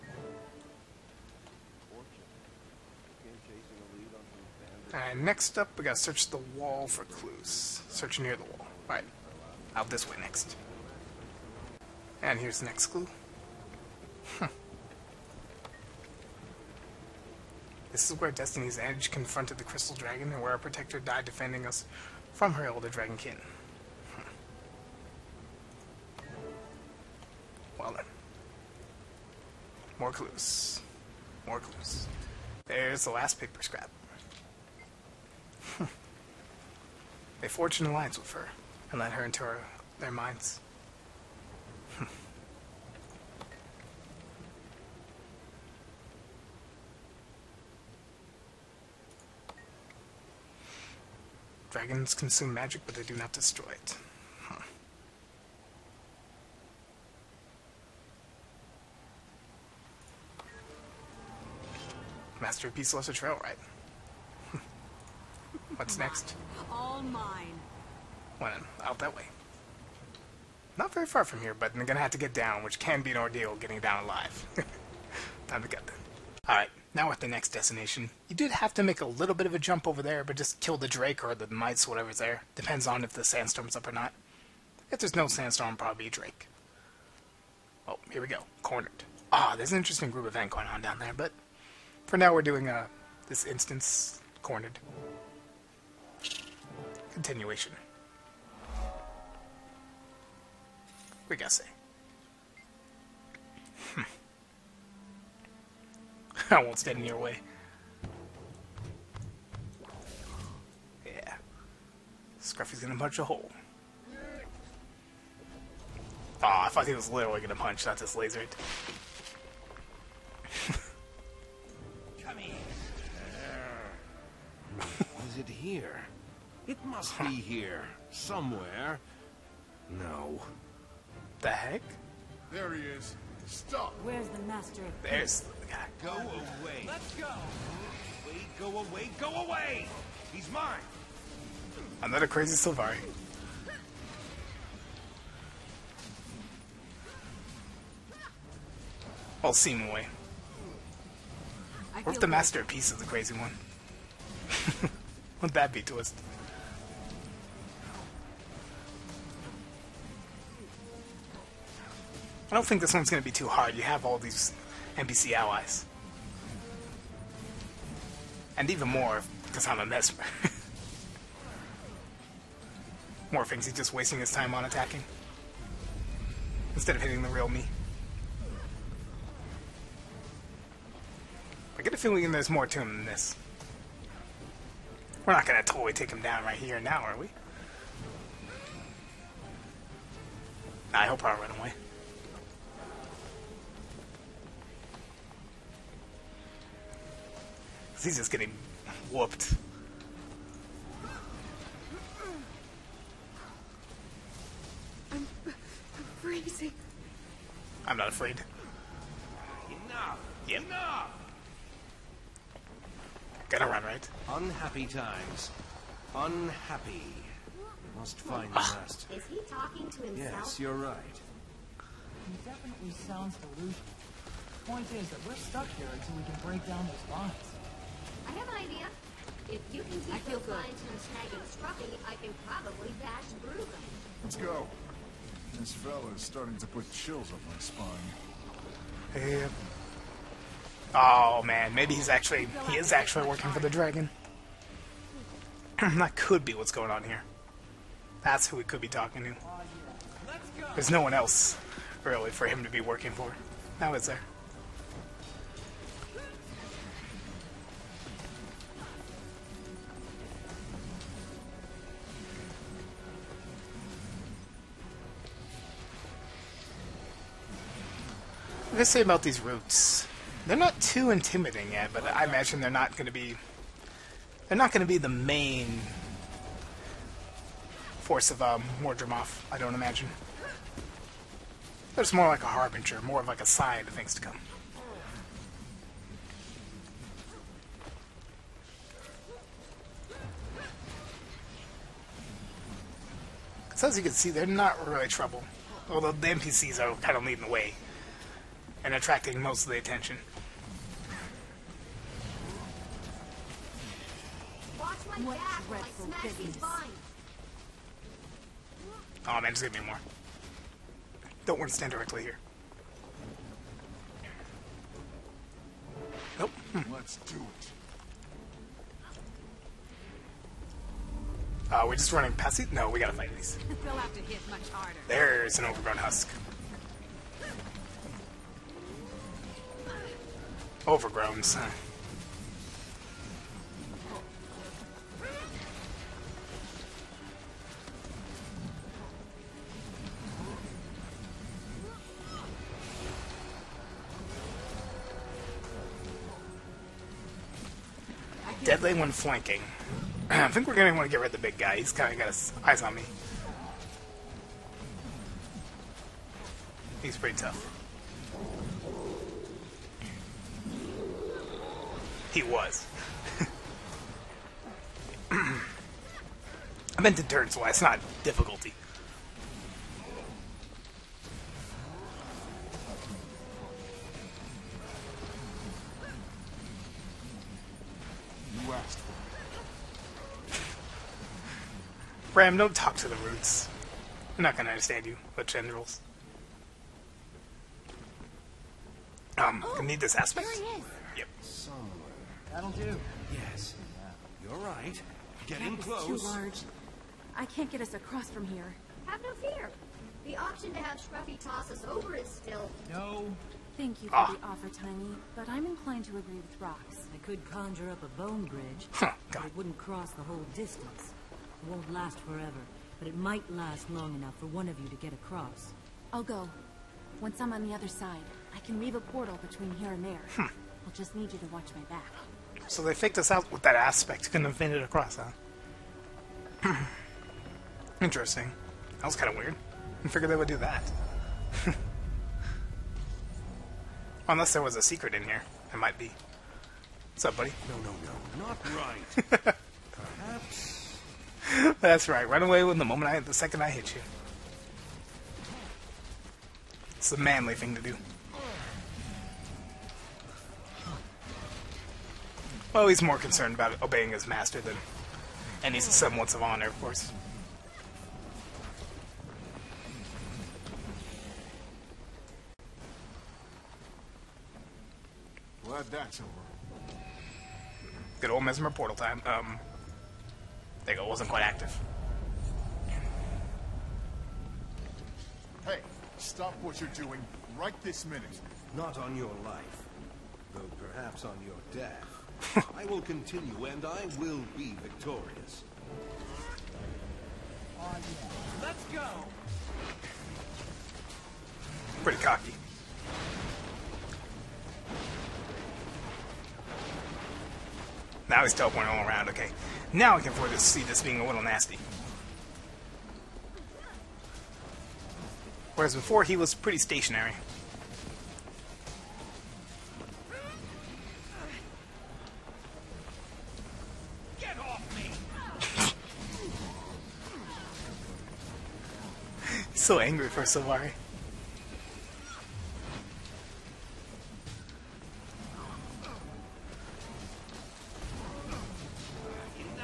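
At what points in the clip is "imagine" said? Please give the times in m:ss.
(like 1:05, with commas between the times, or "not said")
4:32, 4:39.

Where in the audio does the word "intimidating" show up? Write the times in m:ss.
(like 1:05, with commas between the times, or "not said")
4:31.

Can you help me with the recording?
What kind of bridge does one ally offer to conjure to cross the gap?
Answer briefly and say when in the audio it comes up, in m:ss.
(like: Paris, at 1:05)
A bone bridge, at 6:48.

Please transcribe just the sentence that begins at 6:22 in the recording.
Ram, don't talk to the roots.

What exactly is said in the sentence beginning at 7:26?
It's the manly thing to do.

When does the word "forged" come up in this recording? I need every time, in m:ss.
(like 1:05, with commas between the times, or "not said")
0:37.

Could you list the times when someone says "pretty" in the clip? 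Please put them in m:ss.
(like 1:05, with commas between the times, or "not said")
5:57, 8:12, 8:26.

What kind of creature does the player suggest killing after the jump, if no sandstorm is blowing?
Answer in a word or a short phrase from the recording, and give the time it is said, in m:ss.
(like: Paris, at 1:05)
A drake, at 1:25.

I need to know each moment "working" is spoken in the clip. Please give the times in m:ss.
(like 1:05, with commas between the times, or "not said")
4:03, 4:12.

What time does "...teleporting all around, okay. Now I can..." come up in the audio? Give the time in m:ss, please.
8:18.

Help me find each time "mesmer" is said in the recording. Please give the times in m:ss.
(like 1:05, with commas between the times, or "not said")
2:49, 7:48.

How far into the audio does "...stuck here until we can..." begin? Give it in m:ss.
3:45.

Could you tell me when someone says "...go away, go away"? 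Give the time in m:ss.
2:18.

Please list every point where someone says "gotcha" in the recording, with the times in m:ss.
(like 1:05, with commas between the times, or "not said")
not said.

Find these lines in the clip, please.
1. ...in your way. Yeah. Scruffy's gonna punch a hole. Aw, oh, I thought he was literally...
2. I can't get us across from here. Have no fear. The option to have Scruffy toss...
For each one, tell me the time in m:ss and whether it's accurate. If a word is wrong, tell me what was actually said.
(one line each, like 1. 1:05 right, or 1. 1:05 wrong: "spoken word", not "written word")
1. 1:46 right
2. 6:37 right.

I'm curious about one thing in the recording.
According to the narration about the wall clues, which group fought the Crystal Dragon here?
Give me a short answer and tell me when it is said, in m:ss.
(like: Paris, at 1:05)
Destiny's Edge, at 0:18.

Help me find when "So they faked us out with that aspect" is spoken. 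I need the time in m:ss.
7:02.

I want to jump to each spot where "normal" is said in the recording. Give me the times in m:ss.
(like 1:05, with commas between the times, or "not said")
not said.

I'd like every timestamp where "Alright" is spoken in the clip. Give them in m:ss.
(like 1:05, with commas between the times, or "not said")
0:08, 1:16.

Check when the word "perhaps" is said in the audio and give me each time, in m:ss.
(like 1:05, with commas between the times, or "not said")
7:19, 8:00.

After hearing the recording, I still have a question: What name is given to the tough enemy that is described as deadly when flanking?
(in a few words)
Overgrown husk.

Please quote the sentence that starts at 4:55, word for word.
Although the NPCs are kind of leading the way and attracting most of the attention.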